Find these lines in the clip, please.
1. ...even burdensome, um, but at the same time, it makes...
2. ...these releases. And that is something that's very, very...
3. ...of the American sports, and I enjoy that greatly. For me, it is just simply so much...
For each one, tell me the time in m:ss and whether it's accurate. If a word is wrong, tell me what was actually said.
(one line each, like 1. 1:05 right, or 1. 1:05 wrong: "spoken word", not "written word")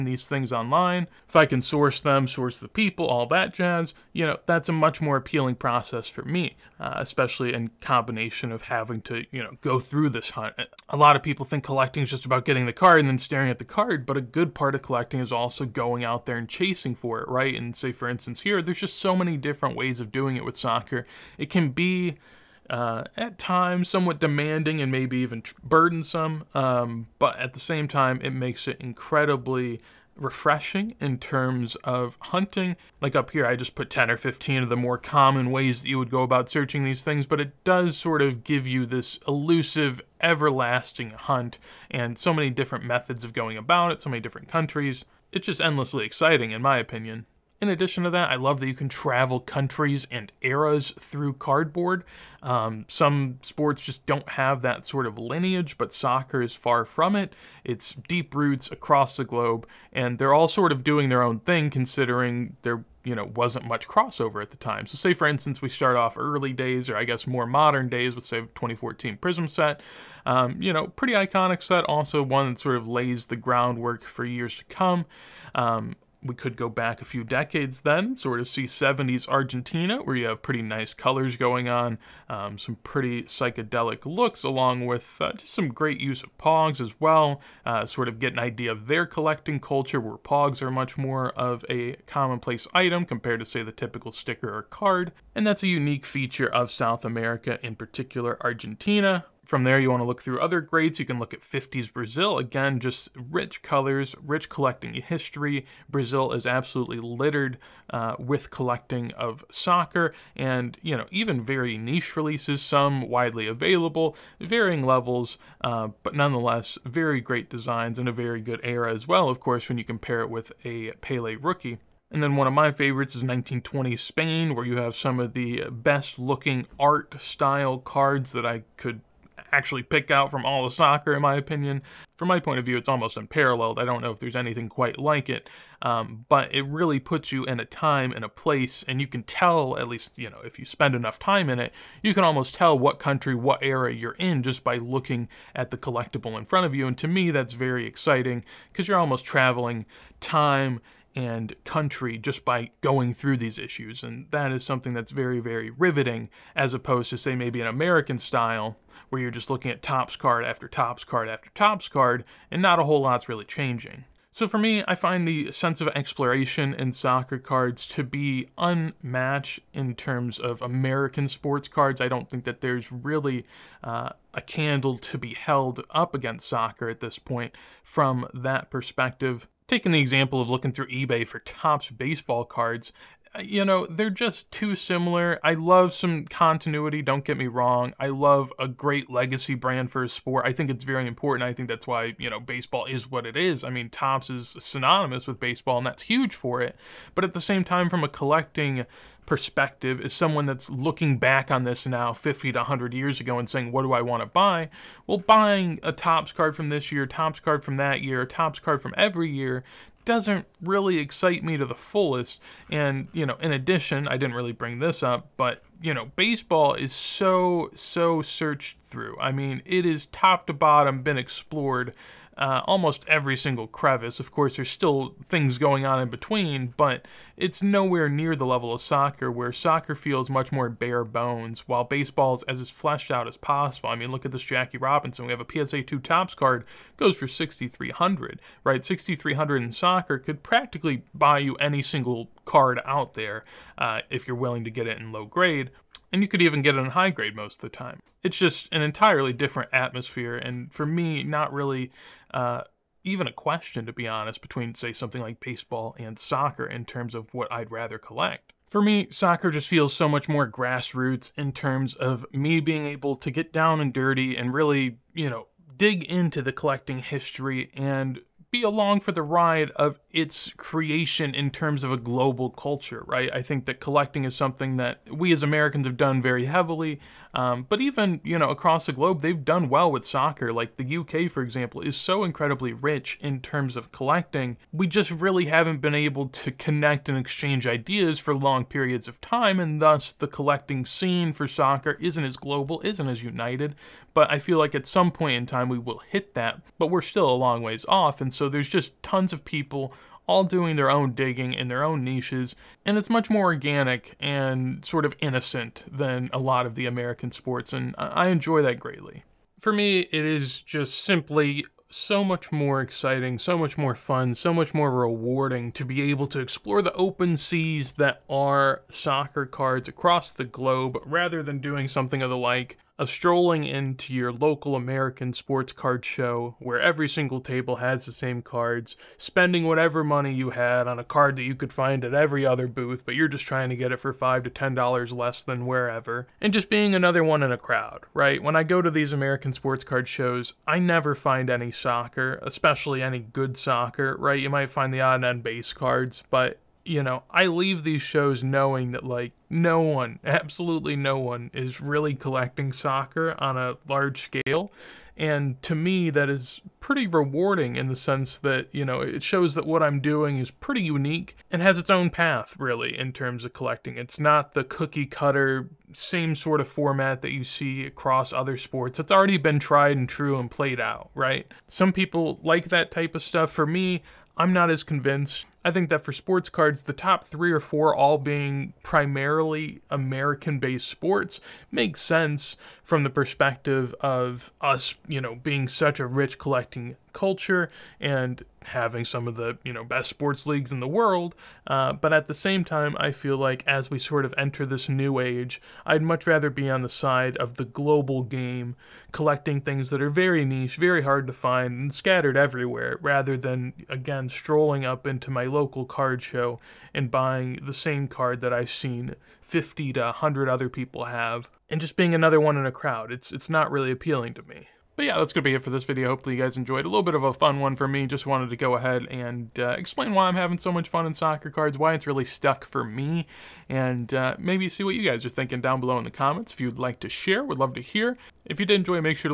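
1. 0:25 right
2. 2:33 wrong: "issues", not "releases"
3. 5:06 right.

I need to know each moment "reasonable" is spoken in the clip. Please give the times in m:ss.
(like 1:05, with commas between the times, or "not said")
not said.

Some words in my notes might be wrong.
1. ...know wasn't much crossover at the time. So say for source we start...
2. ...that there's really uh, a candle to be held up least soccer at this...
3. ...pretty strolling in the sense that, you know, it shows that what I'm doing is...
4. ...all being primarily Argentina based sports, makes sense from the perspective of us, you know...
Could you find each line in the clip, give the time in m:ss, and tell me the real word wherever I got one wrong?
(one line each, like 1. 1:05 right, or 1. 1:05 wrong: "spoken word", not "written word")
1. 1:03 wrong: "instance", not "source"
2. 2:52 wrong: "against", not "least"
3. 5:56 wrong: "rewarding", not "strolling"
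4. 6:17 wrong: "American", not "Argentina".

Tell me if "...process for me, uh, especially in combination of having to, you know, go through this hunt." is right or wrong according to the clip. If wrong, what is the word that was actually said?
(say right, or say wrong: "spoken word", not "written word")
right.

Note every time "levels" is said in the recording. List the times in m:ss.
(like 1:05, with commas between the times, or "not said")
1:54, 3:48.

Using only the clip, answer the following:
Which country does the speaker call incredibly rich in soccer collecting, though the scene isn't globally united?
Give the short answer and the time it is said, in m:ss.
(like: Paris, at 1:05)
UK, at 4:40.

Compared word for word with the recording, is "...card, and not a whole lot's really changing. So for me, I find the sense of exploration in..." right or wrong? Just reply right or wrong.
right.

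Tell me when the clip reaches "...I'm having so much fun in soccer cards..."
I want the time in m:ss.
7:00.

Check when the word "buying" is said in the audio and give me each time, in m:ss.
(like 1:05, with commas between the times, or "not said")
3:25, 6:47.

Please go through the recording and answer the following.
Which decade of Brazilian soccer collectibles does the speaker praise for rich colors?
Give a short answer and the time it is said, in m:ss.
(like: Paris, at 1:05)
1950s, at 1:41.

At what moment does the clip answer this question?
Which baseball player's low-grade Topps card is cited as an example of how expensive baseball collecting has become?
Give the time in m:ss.
3:54.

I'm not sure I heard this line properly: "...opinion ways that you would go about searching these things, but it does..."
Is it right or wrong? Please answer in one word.
wrong.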